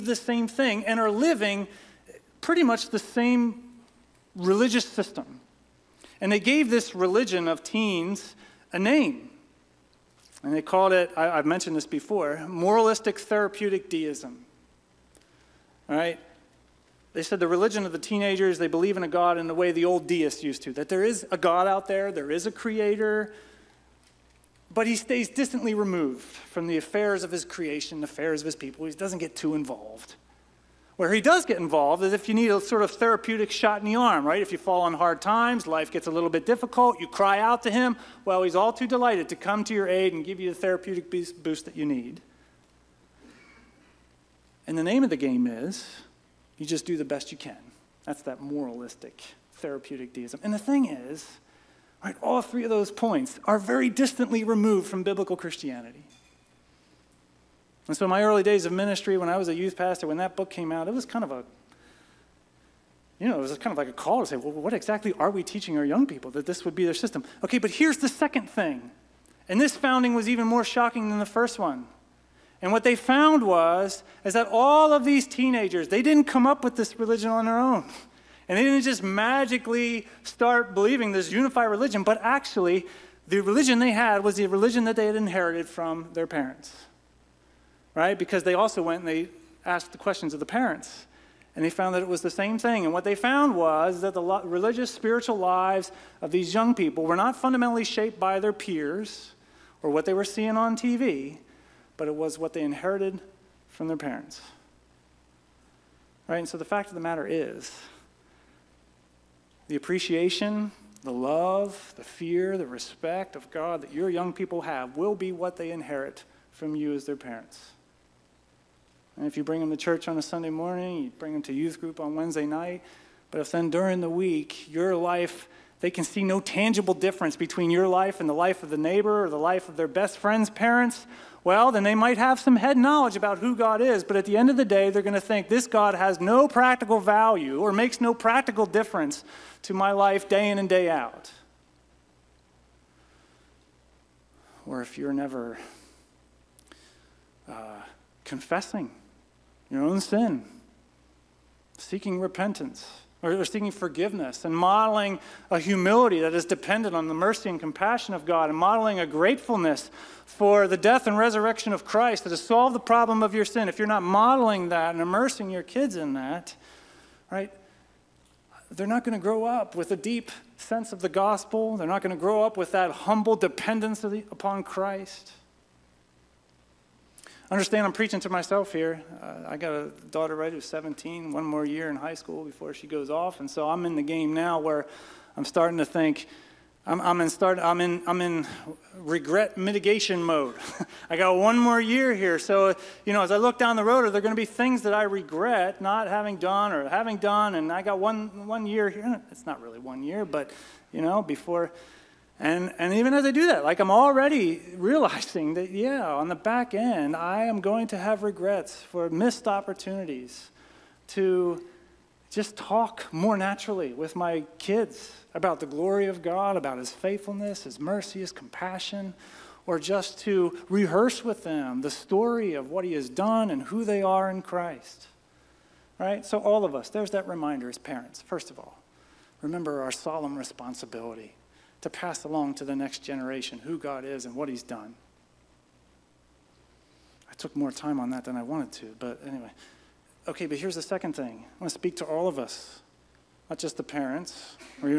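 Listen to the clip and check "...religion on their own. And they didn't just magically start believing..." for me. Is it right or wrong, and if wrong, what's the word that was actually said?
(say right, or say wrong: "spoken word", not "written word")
right.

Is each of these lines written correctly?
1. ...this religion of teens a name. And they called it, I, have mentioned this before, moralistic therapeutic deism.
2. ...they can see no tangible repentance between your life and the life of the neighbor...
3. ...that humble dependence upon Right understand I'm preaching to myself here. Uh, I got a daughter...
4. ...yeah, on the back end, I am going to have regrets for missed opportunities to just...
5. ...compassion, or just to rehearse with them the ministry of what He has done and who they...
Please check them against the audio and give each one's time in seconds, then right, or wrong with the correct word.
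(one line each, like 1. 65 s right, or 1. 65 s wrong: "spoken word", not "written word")
1. 6 s right
2. 125 s wrong: "difference", not "repentance"
3. 172 s wrong: "Christ", not "Right"
4. 205 s right
5. 218 s wrong: "story", not "ministry".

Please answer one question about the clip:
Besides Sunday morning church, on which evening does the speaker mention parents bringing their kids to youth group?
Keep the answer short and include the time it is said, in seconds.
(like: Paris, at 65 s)
Wednesday night, at 122 s.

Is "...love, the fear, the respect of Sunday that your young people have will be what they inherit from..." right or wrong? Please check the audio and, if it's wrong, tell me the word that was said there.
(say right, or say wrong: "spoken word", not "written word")
wrong: "God", not "Sunday".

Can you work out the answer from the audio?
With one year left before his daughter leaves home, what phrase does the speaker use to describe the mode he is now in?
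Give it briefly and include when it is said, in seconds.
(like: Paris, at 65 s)
regret mitigation mode, at 188 s.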